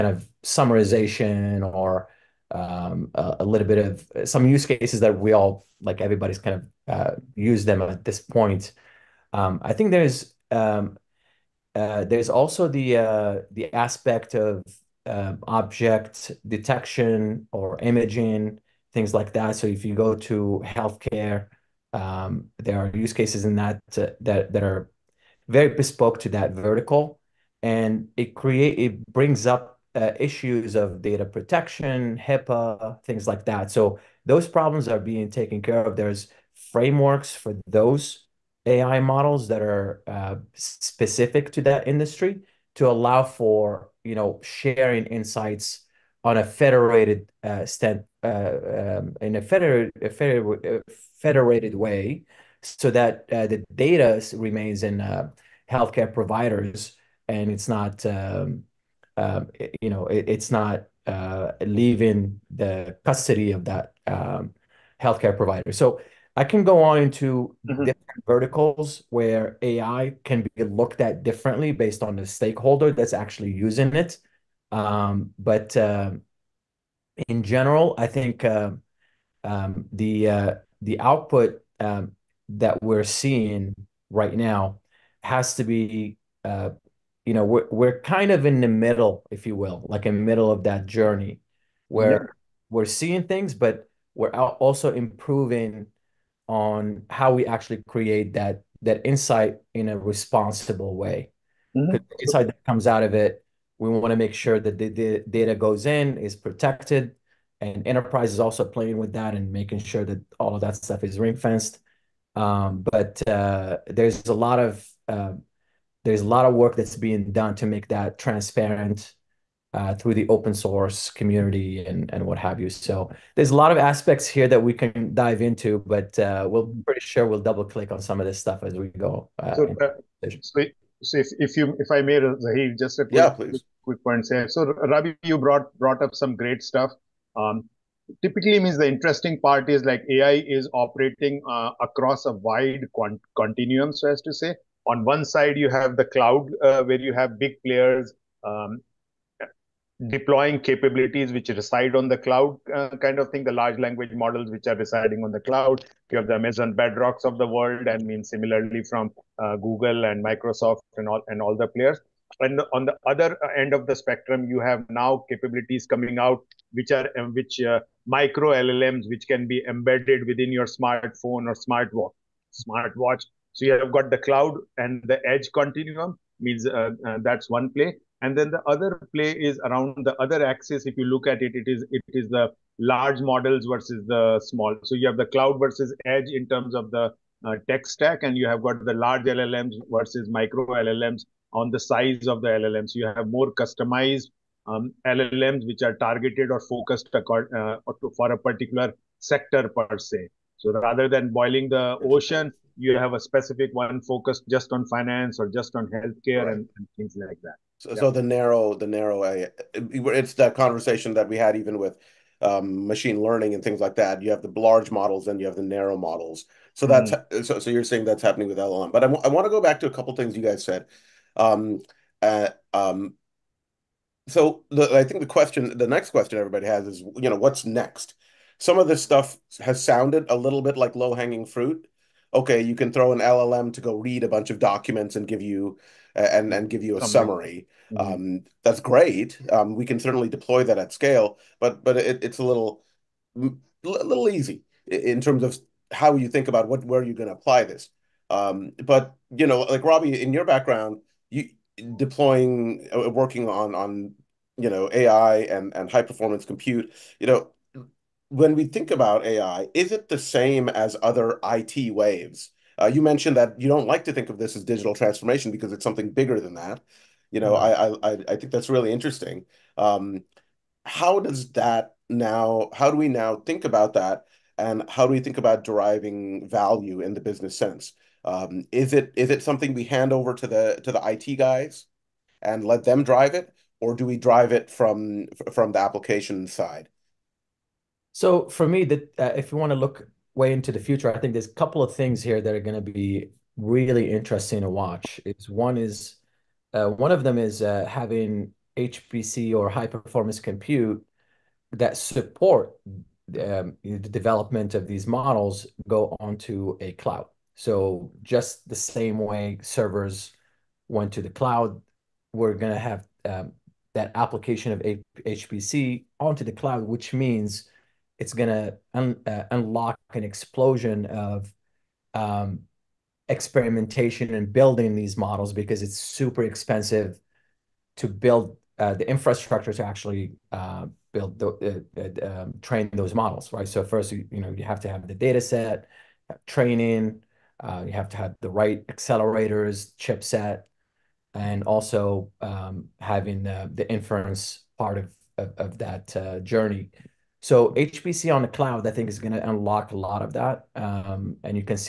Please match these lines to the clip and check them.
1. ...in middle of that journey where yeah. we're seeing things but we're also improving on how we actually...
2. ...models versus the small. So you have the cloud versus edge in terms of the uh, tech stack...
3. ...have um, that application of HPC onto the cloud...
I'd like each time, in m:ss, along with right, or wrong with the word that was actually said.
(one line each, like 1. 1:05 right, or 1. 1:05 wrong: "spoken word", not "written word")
1. 1:30 right
2. 3:03 right
3. 5:12 right.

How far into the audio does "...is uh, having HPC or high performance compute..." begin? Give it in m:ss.
4:57.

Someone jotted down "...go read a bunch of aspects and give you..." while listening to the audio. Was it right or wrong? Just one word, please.
wrong.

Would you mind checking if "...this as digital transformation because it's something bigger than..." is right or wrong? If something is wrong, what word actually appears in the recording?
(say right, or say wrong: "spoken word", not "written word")
right.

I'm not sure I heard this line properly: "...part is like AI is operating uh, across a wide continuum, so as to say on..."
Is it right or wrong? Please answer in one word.
right.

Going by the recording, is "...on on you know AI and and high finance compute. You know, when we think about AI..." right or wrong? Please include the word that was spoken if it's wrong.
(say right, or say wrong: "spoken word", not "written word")
wrong: "performance", not "finance".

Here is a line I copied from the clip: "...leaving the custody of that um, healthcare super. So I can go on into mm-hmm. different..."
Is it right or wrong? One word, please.
wrong.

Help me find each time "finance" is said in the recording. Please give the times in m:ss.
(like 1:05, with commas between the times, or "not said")
3:24.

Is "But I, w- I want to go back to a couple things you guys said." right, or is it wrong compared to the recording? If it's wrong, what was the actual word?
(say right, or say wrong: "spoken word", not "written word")
right.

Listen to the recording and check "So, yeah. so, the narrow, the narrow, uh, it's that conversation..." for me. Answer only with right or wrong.
right.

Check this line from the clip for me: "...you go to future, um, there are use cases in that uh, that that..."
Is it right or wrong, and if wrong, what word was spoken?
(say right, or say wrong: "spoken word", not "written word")
wrong: "healthcare", not "future".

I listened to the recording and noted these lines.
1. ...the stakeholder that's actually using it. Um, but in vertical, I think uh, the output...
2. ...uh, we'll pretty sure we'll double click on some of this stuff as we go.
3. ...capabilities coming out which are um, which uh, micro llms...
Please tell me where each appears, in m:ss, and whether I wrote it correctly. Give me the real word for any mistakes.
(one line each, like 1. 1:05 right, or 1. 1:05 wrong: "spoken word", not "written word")
1. 1:12 wrong: "general", not "vertical"
2. 2:06 right
3. 2:45 right.